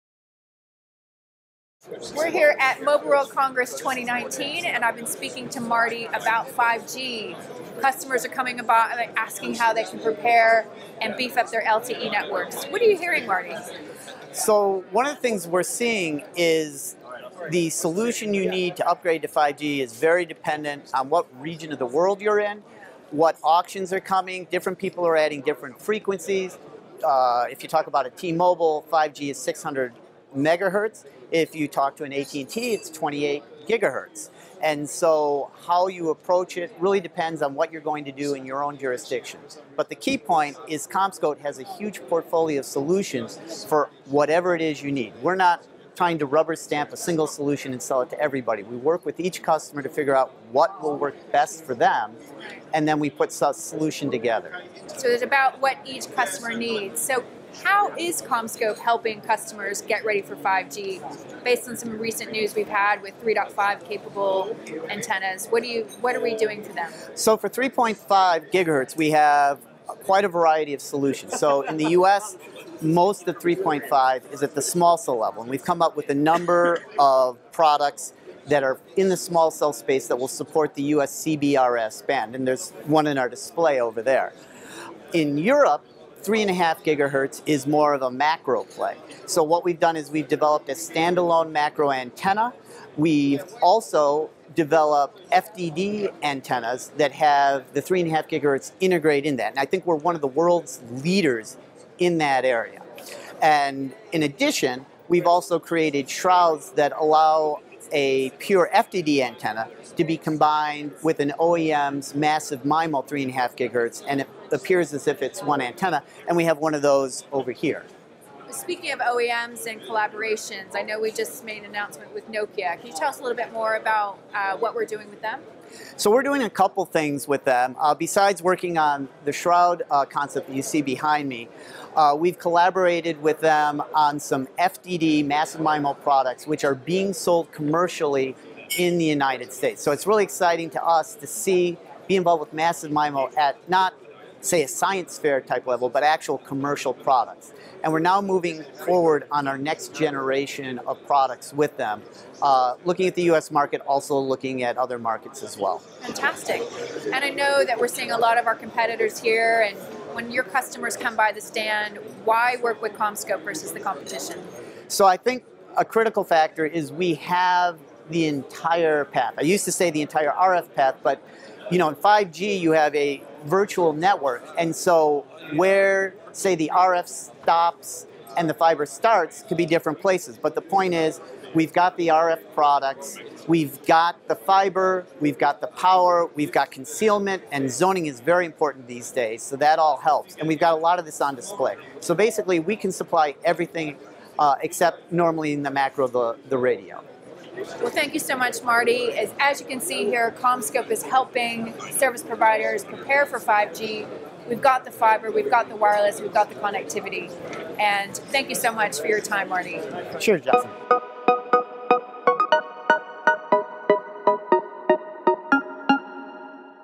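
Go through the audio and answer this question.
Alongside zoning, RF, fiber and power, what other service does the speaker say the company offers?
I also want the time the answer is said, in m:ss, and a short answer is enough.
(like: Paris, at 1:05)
Concealment, at 3:06.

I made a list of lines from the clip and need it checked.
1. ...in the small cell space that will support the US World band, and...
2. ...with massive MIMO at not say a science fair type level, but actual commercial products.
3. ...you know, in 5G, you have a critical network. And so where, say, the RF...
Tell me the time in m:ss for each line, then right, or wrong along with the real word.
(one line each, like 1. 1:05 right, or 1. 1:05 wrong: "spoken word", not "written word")
1. 1:18 wrong: "CBRS", not "World"
2. 2:22 right
3. 2:51 wrong: "virtual", not "critical".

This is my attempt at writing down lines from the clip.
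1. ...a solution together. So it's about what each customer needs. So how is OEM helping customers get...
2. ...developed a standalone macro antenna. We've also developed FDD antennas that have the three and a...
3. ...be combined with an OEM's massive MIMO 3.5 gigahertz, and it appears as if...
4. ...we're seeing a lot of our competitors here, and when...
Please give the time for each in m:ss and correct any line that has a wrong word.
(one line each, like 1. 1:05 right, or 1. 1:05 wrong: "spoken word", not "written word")
1. 0:53 wrong: "CommScope", not "OEM"
2. 1:30 right
3. 1:50 right
4. 2:37 right.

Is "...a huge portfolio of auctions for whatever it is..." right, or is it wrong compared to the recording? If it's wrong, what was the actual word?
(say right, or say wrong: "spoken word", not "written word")
wrong: "solutions", not "auctions".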